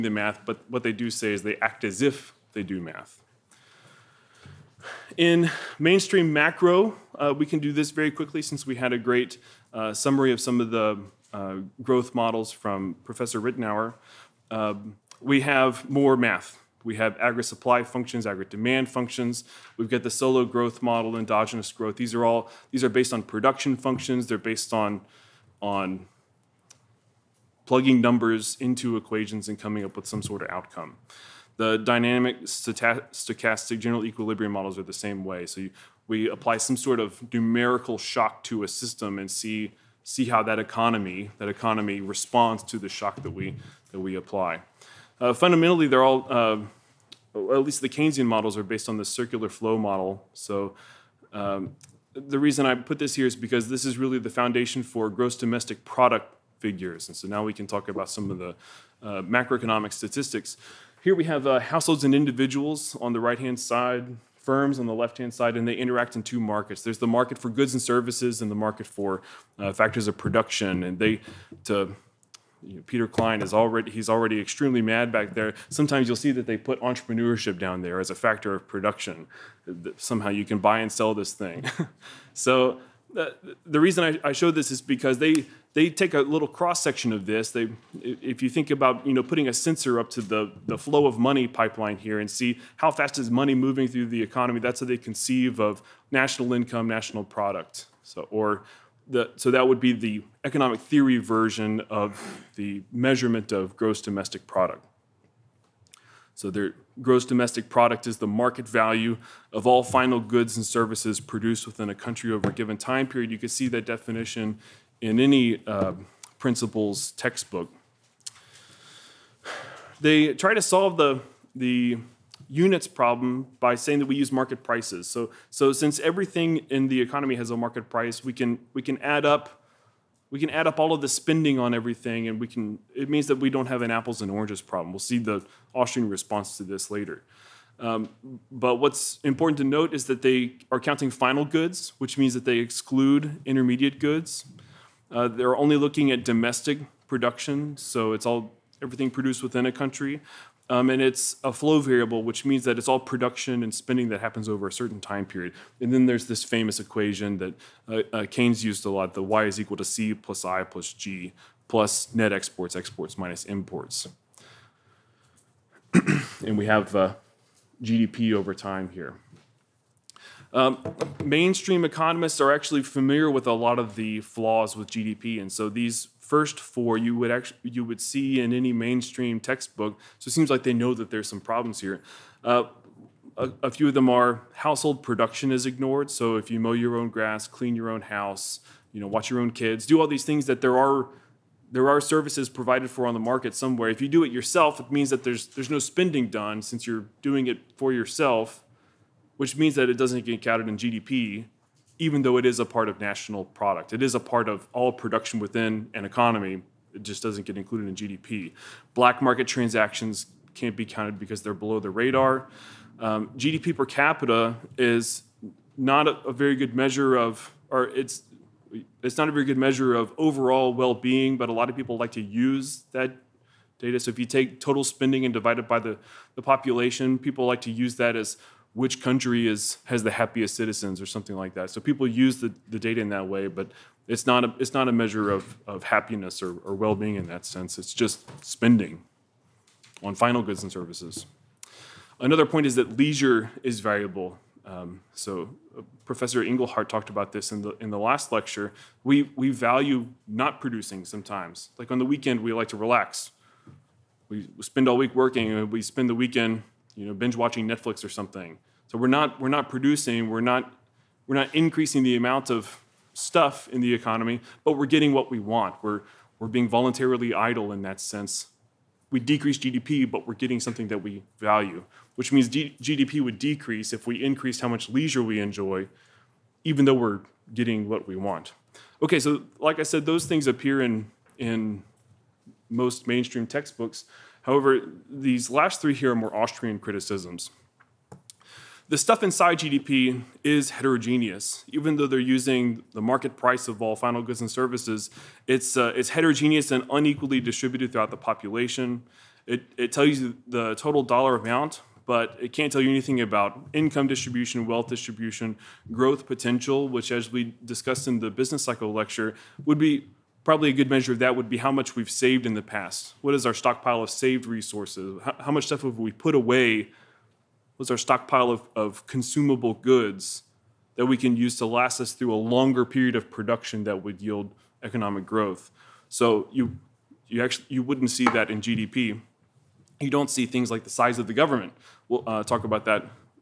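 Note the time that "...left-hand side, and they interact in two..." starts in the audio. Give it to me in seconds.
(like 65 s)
65 s.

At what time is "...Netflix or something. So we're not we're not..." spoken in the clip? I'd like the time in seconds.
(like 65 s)
257 s.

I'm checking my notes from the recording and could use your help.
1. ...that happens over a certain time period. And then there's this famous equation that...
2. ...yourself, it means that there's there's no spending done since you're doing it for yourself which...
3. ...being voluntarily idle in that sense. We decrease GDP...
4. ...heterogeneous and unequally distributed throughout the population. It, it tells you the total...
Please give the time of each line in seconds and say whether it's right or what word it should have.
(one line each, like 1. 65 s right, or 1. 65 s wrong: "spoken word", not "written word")
1. 154 s right
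2. 194 s right
3. 266 s right
4. 296 s right.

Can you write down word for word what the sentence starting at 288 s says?
The stuff inside GDP is heterogeneous.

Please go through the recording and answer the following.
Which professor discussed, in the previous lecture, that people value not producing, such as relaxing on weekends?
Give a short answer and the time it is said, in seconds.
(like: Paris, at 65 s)
Professor Engelhardt, at 246 s.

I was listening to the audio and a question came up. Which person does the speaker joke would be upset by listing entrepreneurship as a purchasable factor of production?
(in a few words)
Peter Klein.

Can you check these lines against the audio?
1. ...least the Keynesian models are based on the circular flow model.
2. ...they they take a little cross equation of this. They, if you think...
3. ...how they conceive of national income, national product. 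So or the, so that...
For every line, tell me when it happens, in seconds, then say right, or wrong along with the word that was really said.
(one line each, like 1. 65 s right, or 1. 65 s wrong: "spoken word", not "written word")
1. 47 s right
2. 85 s wrong: "section", not "equation"
3. 94 s right.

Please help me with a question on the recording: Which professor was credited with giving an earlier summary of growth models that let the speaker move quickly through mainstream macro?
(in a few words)
Professor Ritenour.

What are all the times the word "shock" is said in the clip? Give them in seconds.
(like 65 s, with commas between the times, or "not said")
37 s, 42 s.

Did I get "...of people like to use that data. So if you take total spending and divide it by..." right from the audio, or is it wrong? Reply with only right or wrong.
right.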